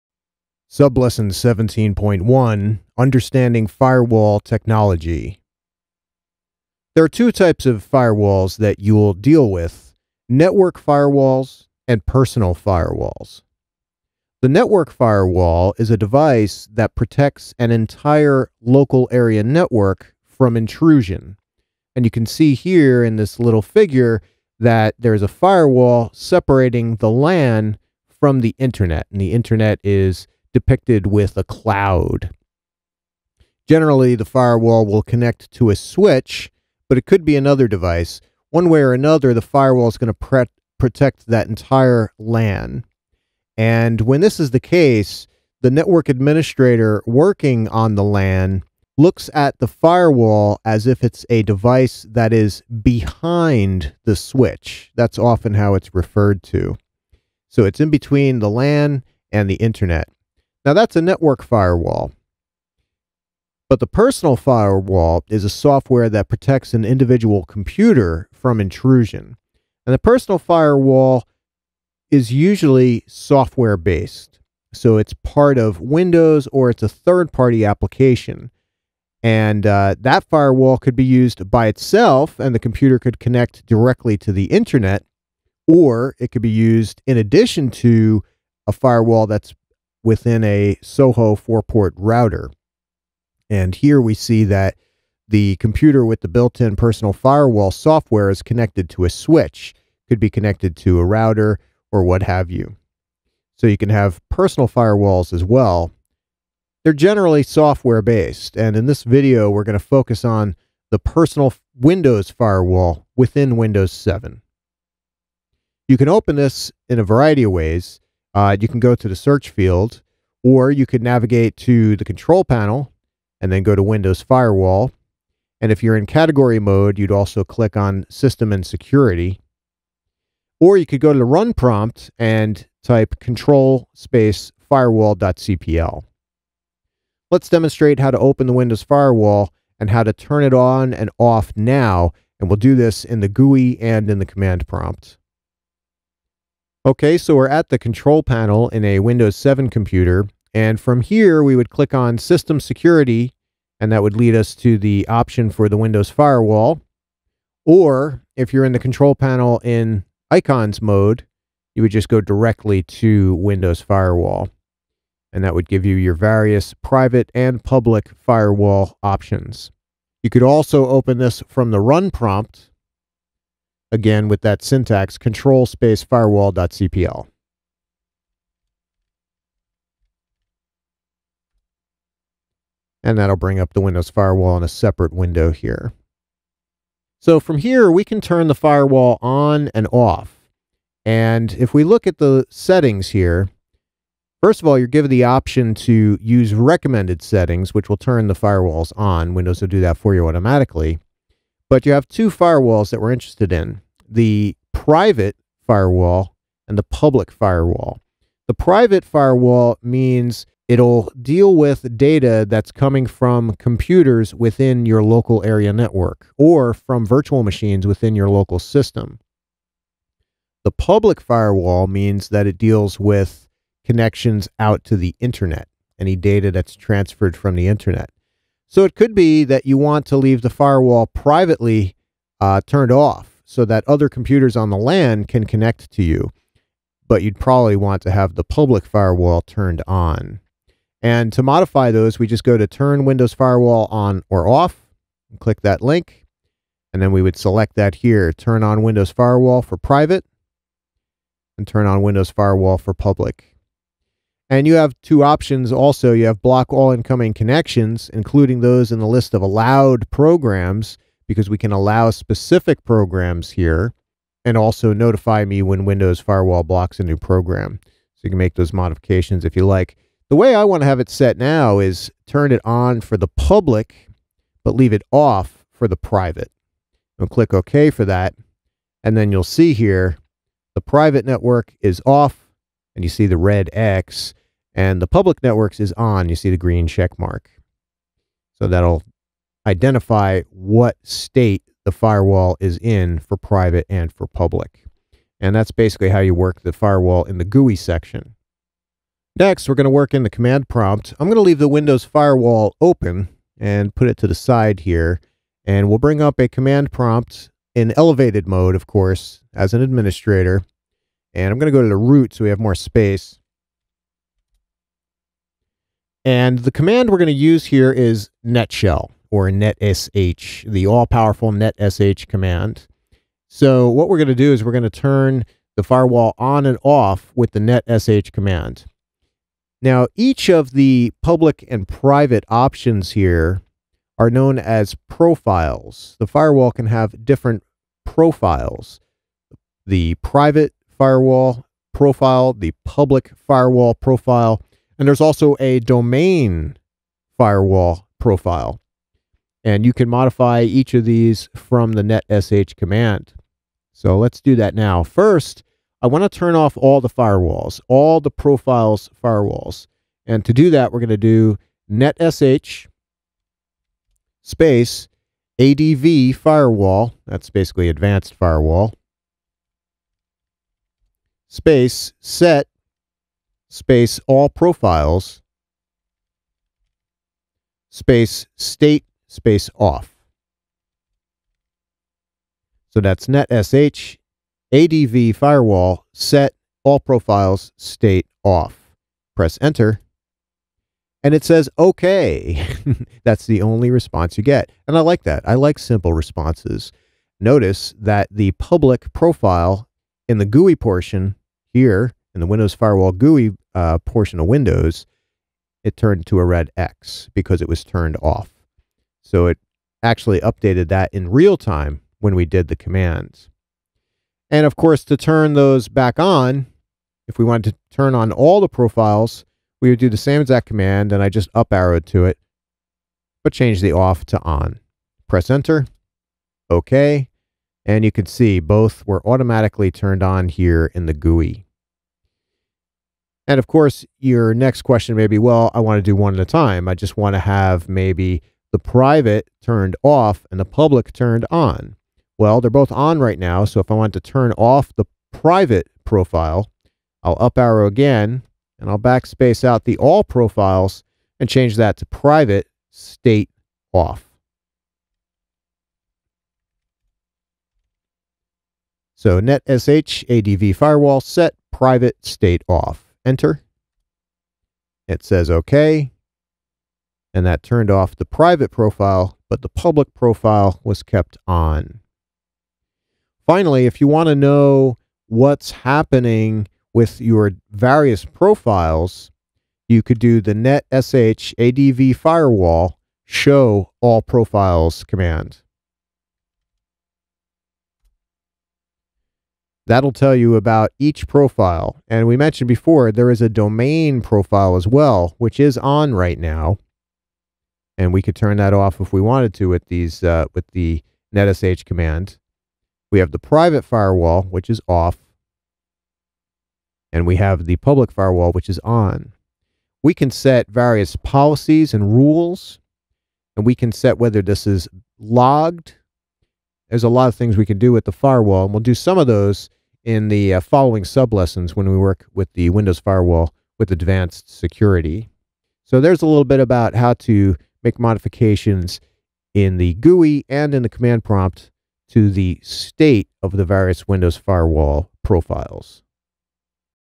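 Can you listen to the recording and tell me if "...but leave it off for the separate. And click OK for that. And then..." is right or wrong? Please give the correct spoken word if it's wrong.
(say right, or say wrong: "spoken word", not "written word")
wrong: "private", not "separate".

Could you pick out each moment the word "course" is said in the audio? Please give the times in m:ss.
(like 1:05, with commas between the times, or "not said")
5:08, 6:54, 7:13.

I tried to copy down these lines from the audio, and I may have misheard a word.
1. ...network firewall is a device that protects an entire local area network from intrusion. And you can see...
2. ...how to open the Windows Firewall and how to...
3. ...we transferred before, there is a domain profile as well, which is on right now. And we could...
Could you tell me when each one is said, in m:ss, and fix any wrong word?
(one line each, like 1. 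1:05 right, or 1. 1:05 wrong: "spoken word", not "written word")
1. 0:14 right
2. 2:17 right
3. 8:12 wrong: "mentioned", not "transferred".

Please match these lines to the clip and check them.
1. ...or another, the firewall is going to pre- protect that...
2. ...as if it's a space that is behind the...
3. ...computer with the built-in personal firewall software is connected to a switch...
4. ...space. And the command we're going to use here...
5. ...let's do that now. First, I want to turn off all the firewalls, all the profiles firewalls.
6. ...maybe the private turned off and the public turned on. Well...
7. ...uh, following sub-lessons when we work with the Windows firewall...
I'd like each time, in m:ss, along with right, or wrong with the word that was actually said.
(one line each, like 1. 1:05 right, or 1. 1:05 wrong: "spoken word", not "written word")
1. 0:38 right
2. 0:50 wrong: "device", not "space"
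3. 1:35 right
4. 5:12 right
5. 5:54 right
6. 7:17 right
7. 8:40 right.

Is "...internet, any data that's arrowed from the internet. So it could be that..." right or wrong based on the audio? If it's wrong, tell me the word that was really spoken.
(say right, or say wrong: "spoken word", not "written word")
wrong: "transferred", not "arrowed".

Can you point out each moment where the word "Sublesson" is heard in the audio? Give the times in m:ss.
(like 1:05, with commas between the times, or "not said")
0:00.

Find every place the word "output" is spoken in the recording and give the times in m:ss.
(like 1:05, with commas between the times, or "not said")
not said.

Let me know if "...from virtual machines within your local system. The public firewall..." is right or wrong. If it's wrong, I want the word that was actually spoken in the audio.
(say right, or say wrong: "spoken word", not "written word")
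right.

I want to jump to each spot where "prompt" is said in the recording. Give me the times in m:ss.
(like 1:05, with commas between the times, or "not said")
2:11, 2:24, 2:52, 5:00, 5:06, 8:51.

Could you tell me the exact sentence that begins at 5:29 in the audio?
Now, each of the public and private options here are known as profiles.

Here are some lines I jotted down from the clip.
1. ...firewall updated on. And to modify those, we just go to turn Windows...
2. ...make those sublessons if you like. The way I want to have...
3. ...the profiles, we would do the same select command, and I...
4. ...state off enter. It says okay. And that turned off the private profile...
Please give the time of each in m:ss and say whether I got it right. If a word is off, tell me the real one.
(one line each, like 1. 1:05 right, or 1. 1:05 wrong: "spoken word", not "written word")
1. 3:58 wrong: "turned", not "updated"
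2. 4:28 wrong: "modifications", not "sublessons"
3. 6:58 wrong: "exact", not "select"
4. 7:42 right.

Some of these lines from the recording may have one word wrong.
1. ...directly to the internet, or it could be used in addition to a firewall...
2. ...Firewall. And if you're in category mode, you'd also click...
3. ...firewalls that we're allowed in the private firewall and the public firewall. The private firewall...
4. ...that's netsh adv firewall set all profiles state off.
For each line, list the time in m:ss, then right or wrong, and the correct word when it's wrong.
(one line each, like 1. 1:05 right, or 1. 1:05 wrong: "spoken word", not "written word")
1. 1:23 right
2. 2:04 right
3. 3:22 wrong: "interested", not "allowed"
4. 6:22 right.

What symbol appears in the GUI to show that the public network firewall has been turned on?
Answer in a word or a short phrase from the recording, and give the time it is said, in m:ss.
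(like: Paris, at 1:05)
Green check mark, at 4:46.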